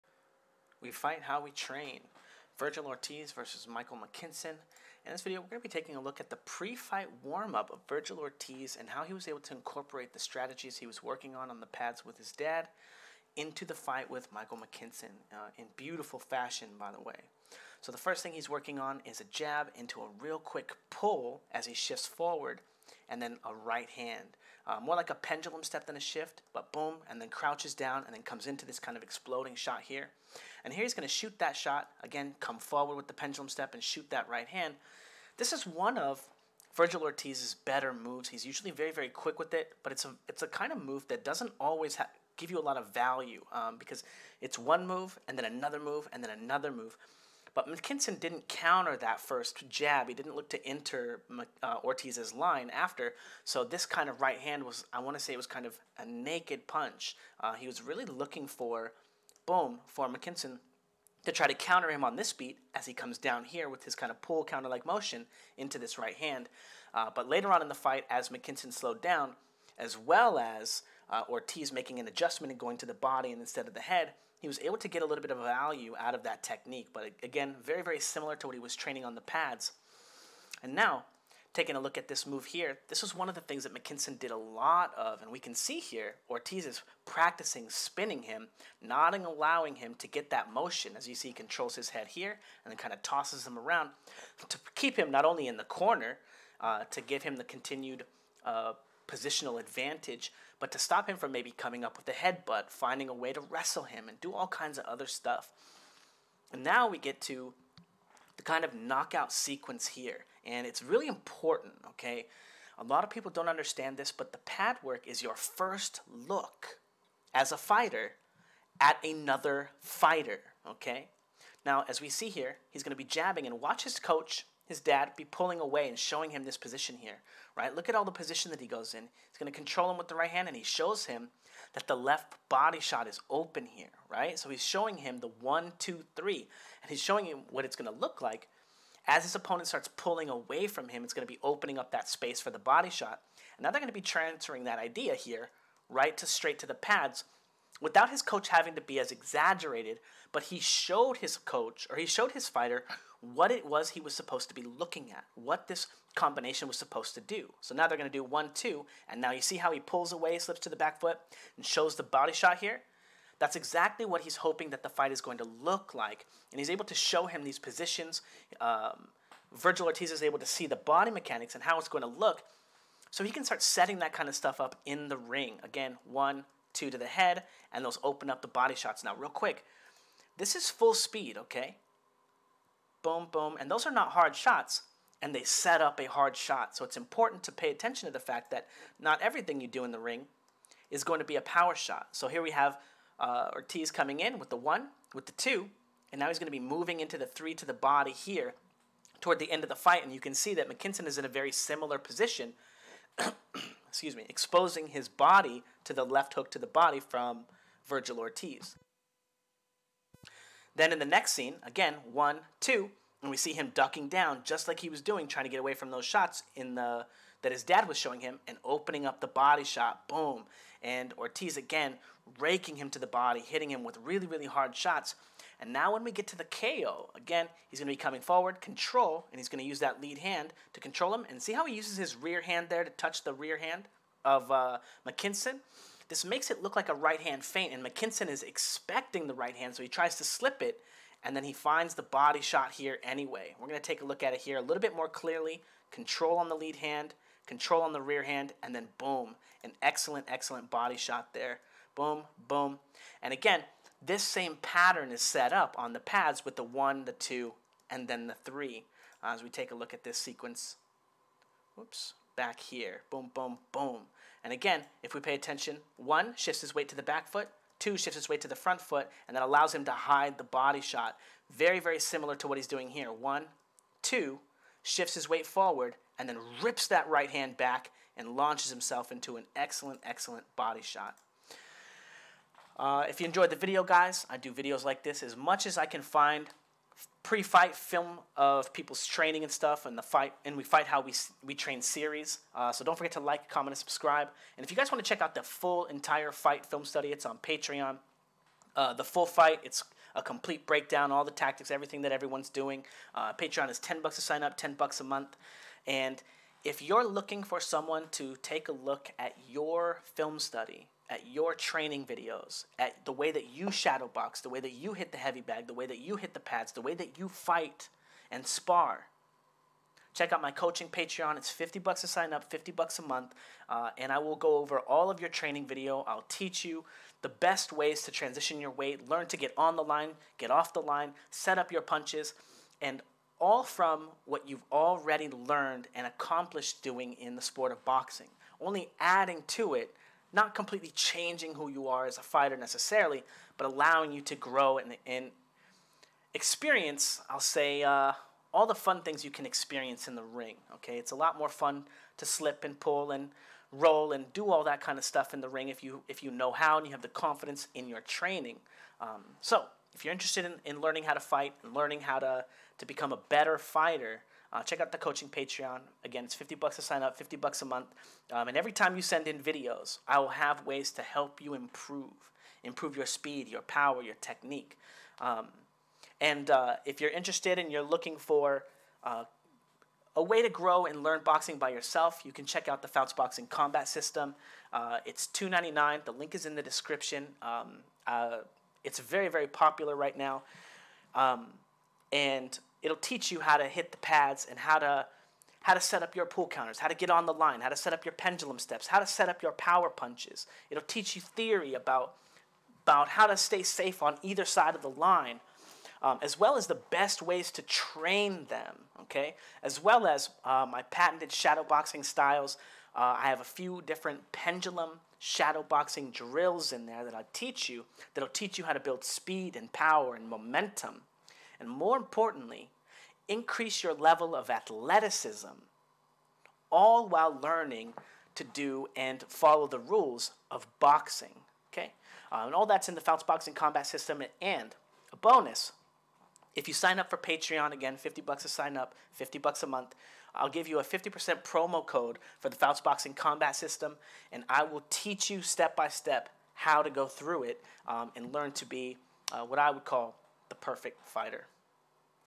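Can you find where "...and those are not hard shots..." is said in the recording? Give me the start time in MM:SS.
03:03.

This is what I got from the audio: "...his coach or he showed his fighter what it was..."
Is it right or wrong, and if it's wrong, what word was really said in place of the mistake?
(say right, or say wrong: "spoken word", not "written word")
right.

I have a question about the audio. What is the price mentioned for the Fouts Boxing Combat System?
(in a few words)
2.99.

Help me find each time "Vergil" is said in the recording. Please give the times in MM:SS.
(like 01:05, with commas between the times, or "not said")
00:02, 00:07, 00:36, 02:49, 03:27.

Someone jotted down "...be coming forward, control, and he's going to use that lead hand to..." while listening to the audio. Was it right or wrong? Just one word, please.
right.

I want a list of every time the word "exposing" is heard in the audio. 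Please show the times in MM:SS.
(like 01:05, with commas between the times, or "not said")
03:24.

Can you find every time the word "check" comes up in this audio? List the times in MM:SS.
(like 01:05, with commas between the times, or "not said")
04:55, 05:20, 06:04, 06:22.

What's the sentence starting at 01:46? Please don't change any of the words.
And now we get to the kind of knockout sequence here, and it's really important, okay?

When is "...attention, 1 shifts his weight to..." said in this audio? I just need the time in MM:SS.
04:25.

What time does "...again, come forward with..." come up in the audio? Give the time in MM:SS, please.
00:32.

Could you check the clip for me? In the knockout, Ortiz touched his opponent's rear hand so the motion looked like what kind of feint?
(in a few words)
right hand feint.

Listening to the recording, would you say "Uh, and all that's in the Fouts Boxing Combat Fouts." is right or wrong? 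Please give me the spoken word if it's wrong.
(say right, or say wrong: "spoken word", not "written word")
wrong: "System", not "Fouts".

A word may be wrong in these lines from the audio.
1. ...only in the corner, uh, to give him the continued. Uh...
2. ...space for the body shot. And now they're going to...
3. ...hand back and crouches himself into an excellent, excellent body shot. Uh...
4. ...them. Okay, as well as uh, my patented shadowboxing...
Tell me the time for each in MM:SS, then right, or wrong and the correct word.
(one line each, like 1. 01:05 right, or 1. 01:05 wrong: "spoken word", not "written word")
1. 01:35 right
2. 02:22 right
3. 04:37 wrong: "launches", not "crouches"
4. 06:48 right.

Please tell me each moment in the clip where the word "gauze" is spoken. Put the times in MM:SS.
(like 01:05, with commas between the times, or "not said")
not said.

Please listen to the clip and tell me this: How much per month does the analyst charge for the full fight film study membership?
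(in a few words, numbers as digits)
$10.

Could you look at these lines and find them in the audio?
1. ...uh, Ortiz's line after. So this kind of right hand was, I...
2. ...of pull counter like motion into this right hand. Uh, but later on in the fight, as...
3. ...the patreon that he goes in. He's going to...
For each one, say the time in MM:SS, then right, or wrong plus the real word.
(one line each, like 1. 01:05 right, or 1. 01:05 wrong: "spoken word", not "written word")
1. 00:51 right
2. 01:04 right
3. 02:08 wrong: "position", not "patreon".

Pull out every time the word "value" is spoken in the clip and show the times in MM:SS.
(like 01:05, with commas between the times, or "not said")
00:42, 01:15.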